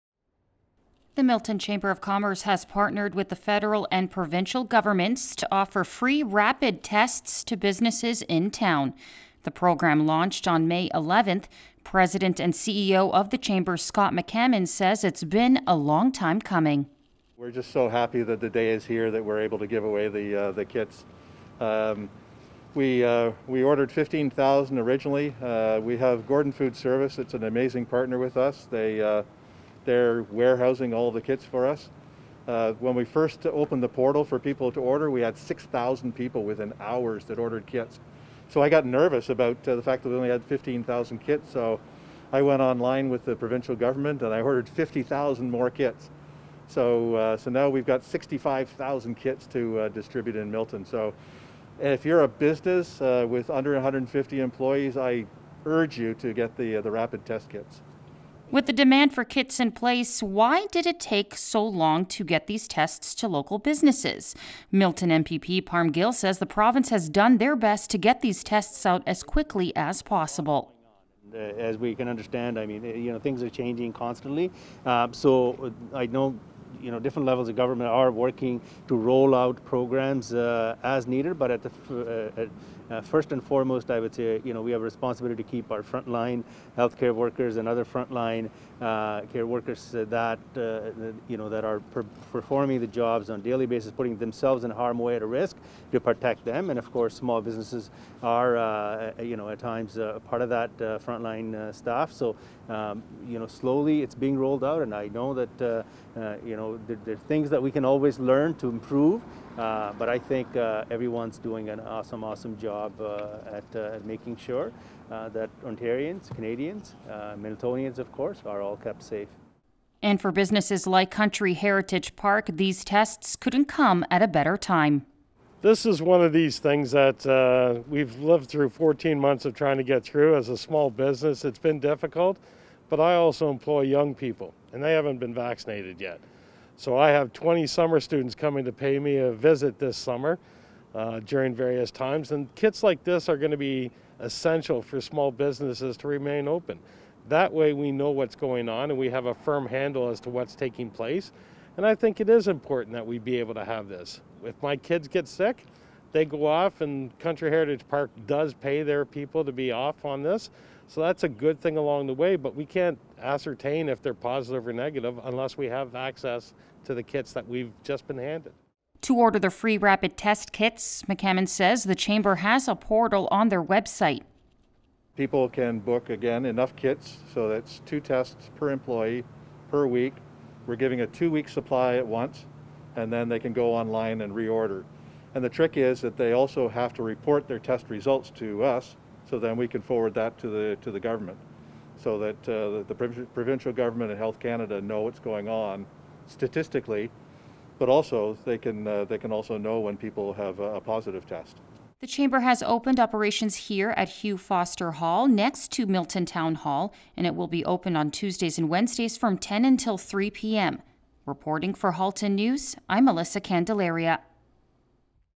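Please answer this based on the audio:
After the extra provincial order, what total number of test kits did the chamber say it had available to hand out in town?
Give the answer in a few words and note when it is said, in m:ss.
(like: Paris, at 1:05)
65,000, at 0:48.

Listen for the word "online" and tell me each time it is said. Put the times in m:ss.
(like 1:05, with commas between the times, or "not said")
0:42, 3:03.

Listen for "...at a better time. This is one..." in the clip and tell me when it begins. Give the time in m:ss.
2:04.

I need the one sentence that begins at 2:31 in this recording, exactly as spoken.
And I think it is important that we be able to have this.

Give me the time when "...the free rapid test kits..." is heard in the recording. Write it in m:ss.
2:49.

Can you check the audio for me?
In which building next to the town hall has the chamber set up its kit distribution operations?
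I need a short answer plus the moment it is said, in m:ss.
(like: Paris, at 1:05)
Hugh Foster Hall, at 3:24.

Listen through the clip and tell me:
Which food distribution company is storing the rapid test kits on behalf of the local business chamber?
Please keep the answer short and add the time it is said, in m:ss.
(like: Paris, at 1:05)
Gordon Food Service, at 0:26.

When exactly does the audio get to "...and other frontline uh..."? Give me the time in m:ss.
1:27.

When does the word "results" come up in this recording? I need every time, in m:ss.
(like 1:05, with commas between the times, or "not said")
3:07.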